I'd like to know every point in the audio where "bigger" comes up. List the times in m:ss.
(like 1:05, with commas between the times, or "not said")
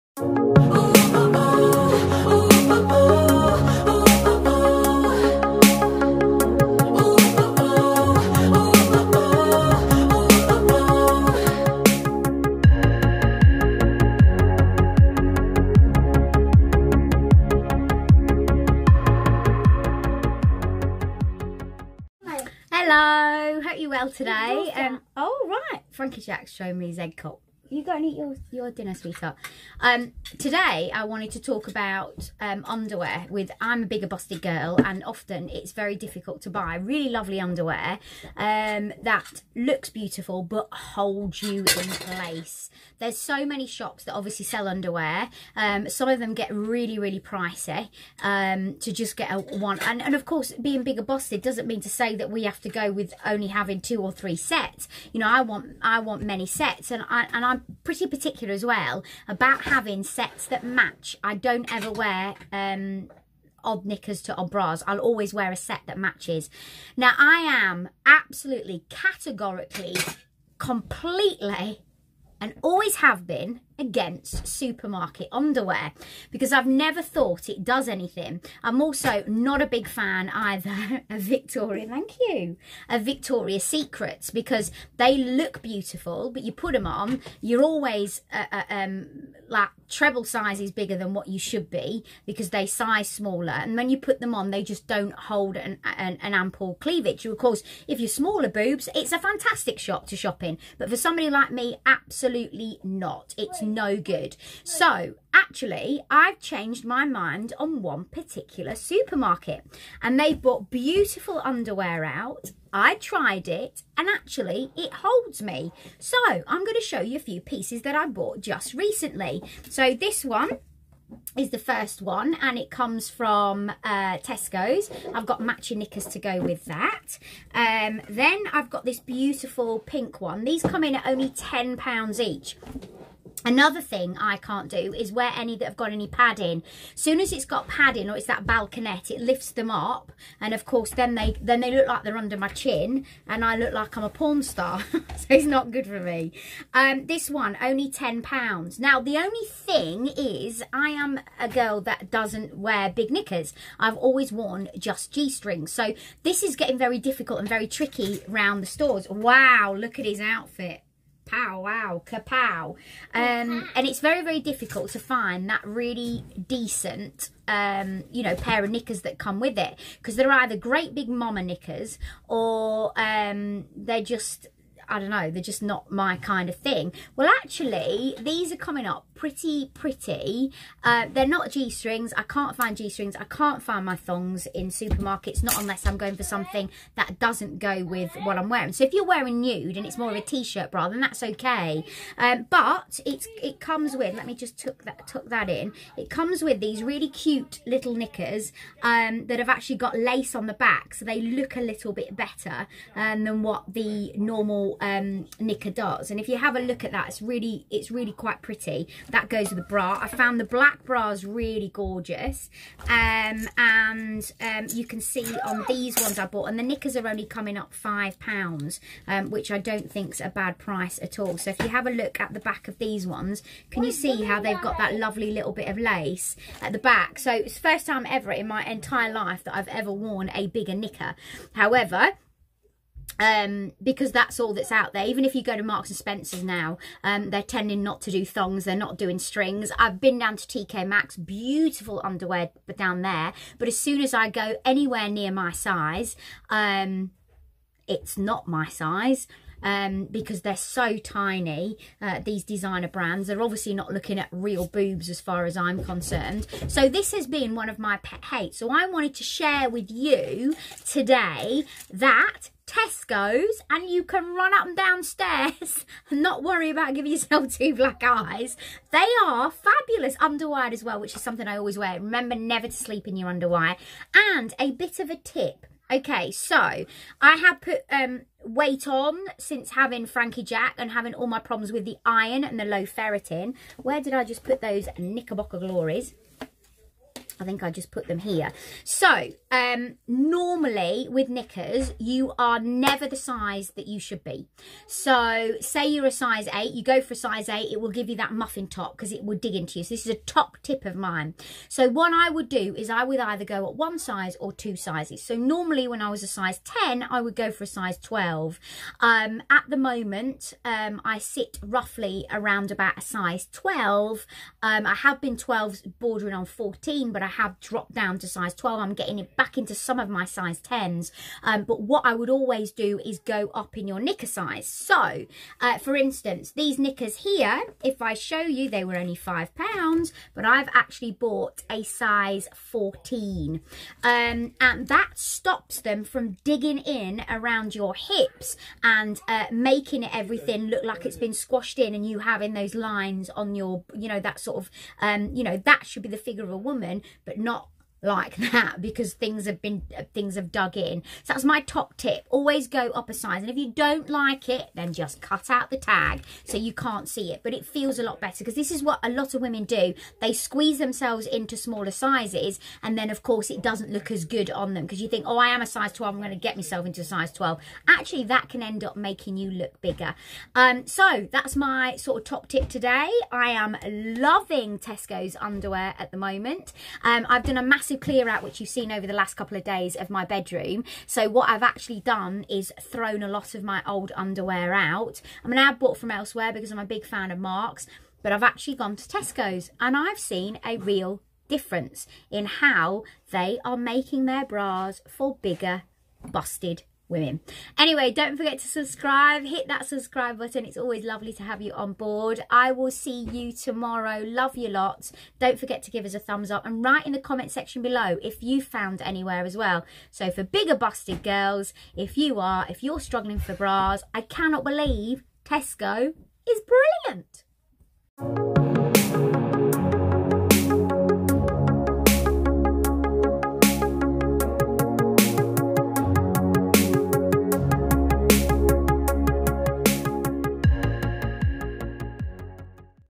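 0:33, 0:50, 1:30, 3:50, 6:09, 6:35, 6:50.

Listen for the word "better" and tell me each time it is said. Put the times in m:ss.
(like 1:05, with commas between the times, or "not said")
3:22, 5:58.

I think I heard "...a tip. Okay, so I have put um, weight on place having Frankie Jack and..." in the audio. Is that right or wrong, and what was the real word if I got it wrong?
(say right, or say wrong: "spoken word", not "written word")
wrong: "since", not "place".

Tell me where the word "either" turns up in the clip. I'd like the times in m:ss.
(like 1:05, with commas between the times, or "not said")
1:20, 2:50, 5:03.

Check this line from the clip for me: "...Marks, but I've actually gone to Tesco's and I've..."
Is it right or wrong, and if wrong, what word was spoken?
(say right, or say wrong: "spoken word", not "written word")
right.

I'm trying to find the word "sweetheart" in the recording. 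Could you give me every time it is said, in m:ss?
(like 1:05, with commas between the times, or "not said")
0:28.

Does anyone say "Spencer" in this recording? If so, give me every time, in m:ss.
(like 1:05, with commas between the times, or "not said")
3:55.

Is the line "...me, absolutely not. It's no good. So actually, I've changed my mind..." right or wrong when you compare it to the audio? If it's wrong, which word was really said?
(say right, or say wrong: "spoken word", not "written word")
right.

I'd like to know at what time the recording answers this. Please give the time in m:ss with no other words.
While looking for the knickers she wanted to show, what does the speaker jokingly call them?
4:44.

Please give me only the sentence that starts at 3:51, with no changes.
However, um, because that's all that's out there.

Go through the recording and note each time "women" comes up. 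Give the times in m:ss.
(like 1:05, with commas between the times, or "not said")
5:59, 6:37.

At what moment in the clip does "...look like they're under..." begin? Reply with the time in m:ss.
2:21.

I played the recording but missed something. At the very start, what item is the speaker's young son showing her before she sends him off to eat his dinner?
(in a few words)
egg cup.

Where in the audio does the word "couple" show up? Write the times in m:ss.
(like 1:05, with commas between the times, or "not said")
6:19.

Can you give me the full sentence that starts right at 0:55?
You know, I want I want many sets and, I, and I'm pretty particular as well about having sets that match.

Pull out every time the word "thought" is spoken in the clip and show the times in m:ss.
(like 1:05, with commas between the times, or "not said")
1:17.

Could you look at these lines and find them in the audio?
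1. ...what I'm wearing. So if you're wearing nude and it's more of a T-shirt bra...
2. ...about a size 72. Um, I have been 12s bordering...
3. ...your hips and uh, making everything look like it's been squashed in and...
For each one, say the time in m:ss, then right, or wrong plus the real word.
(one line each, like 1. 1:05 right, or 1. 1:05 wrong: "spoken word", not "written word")
1. 3:08 right
2. 5:12 wrong: "12", not "72"
3. 5:37 right.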